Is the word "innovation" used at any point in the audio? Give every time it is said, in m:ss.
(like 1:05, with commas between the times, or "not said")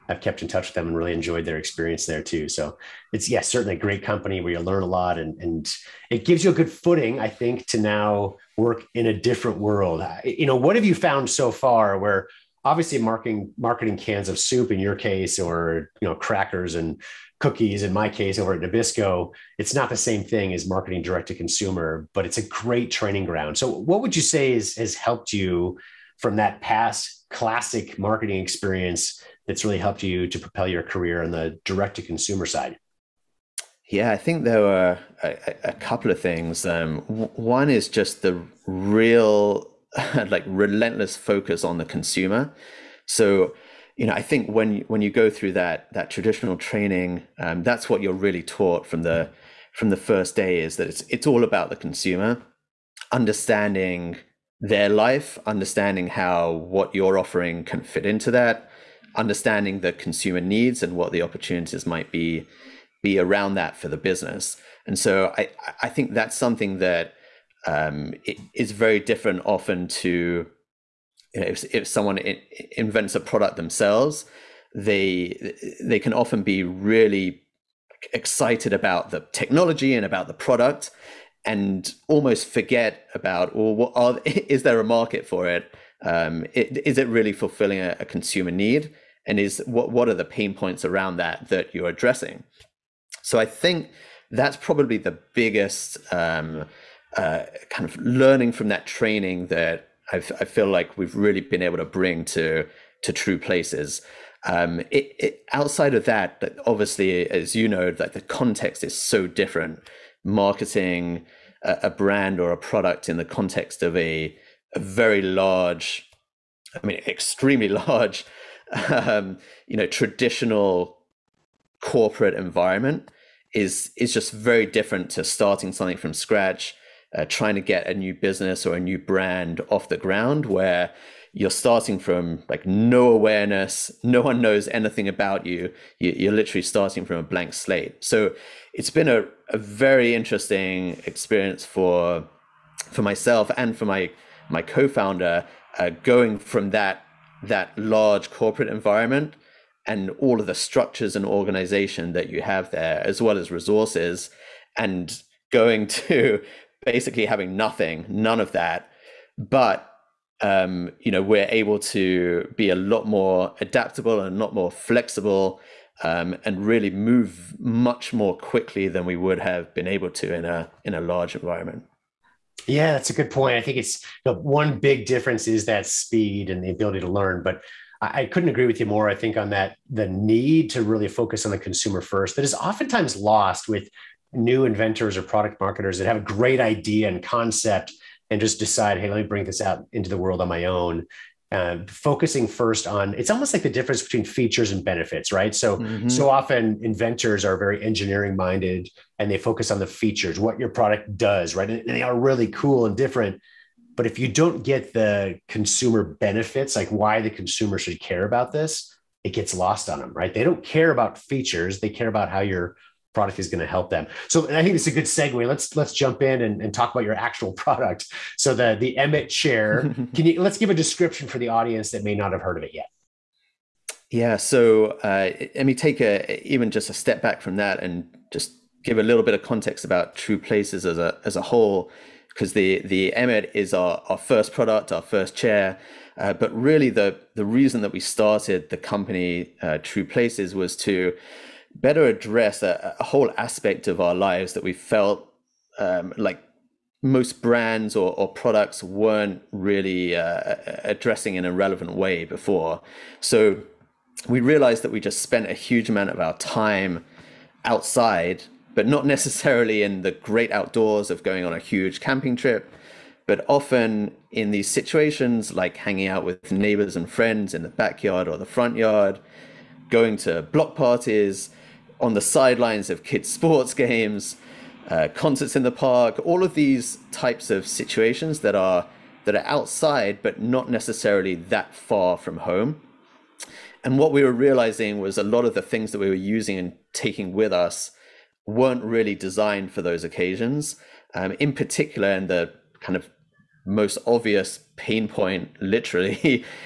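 not said.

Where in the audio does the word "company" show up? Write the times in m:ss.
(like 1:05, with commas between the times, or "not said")
0:04, 3:58.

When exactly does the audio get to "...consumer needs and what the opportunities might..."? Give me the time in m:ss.
0:59.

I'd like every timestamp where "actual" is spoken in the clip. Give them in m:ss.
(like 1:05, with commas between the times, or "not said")
3:37.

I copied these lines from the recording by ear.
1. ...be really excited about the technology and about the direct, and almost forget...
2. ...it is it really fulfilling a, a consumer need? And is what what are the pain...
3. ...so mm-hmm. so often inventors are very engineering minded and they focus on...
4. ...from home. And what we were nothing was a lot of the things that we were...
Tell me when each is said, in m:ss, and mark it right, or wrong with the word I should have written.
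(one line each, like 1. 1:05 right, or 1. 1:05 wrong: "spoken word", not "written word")
1. 1:16 wrong: "product", not "direct"
2. 1:26 right
3. 3:15 right
4. 4:42 wrong: "realizing", not "nothing".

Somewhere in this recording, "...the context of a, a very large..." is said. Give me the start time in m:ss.
1:53.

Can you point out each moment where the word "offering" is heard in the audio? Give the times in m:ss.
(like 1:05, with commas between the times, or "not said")
0:57.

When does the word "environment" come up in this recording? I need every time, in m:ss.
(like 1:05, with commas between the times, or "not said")
2:02, 2:28, 2:51.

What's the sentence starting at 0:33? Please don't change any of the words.
Yeah, I think there were a, a couple of things.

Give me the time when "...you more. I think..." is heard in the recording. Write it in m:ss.
2:58.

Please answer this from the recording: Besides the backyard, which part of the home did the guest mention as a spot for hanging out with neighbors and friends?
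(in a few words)
front yard.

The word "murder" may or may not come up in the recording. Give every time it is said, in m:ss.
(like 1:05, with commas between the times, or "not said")
not said.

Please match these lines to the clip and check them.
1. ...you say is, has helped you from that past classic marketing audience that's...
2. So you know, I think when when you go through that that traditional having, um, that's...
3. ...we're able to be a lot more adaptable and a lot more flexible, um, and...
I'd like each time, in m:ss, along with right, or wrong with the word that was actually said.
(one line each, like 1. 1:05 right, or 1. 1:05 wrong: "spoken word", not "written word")
1. 0:24 wrong: "experience", not "audience"
2. 0:43 wrong: "training", not "having"
3. 2:41 right.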